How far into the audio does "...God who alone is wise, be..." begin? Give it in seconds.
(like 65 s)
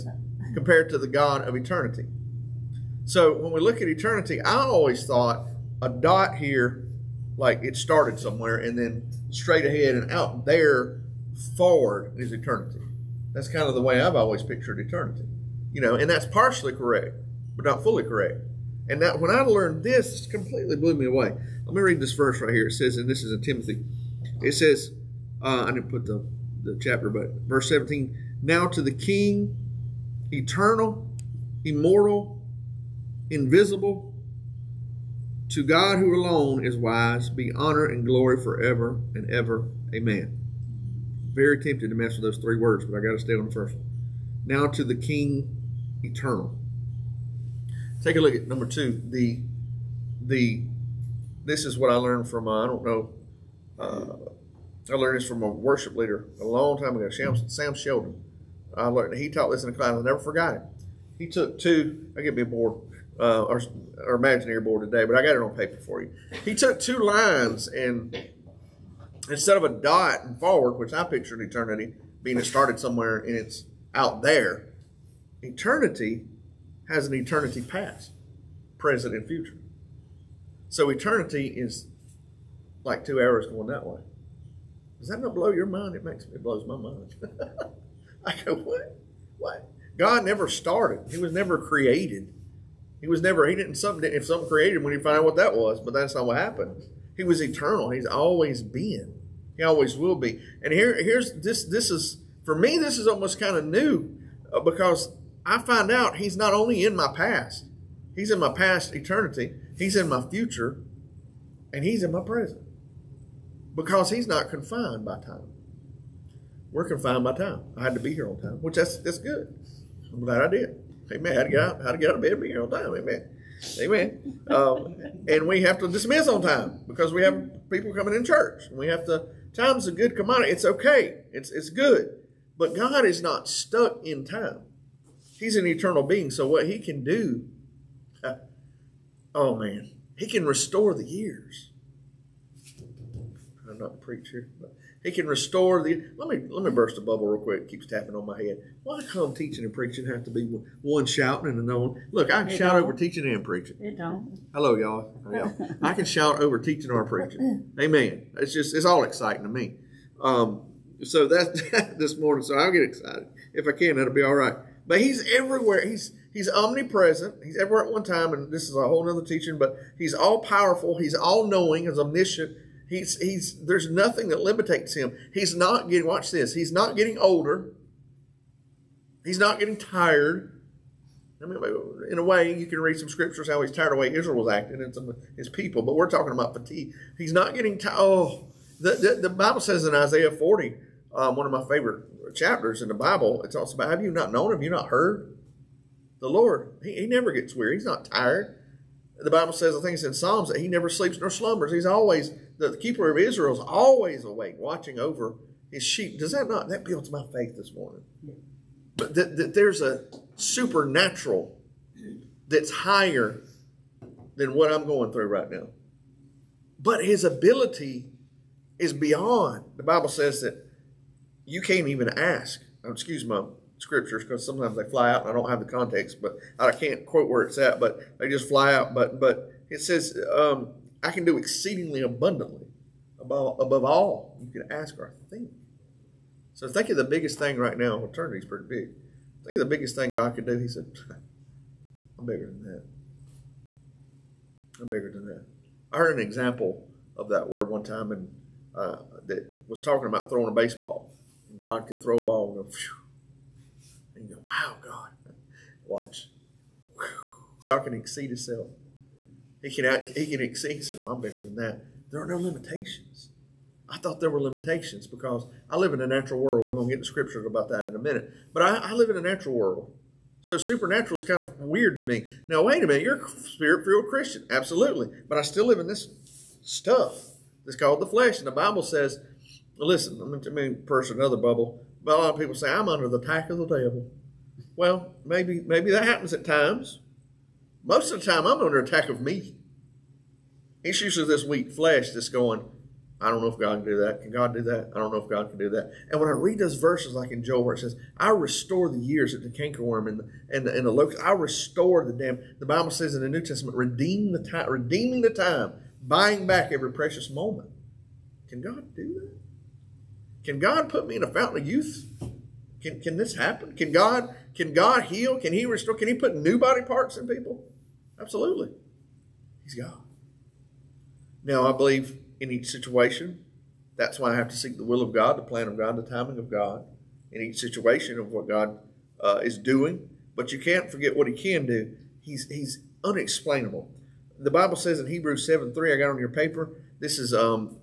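35 s.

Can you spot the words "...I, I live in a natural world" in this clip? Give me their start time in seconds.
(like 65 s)
268 s.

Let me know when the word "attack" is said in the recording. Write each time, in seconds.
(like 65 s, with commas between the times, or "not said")
283 s, 288 s.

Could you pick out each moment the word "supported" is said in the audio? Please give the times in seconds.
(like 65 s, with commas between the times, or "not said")
not said.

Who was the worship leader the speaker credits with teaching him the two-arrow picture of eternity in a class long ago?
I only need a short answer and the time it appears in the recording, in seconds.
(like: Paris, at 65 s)
Sam Sheldon, at 57 s.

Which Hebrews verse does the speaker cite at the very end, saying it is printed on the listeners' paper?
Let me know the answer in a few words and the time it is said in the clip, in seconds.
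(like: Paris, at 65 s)
Hebrews 7:3, at 335 s.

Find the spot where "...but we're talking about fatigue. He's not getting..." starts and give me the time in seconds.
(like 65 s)
185 s.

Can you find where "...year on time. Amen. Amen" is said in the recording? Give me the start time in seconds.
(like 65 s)
122 s.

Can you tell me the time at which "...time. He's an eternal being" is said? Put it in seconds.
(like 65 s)
134 s.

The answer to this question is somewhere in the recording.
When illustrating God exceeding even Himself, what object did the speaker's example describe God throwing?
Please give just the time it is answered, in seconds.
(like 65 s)
250 s.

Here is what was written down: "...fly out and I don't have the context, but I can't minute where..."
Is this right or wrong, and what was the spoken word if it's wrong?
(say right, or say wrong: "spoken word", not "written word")
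wrong: "quote", not "minute".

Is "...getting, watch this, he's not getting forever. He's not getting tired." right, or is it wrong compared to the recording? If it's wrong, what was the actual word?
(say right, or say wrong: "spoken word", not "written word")
wrong: "older", not "forever".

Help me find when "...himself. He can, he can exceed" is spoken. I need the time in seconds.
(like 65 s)
258 s.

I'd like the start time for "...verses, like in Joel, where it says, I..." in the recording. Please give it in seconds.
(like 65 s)
296 s.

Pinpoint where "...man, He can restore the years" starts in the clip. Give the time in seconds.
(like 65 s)
139 s.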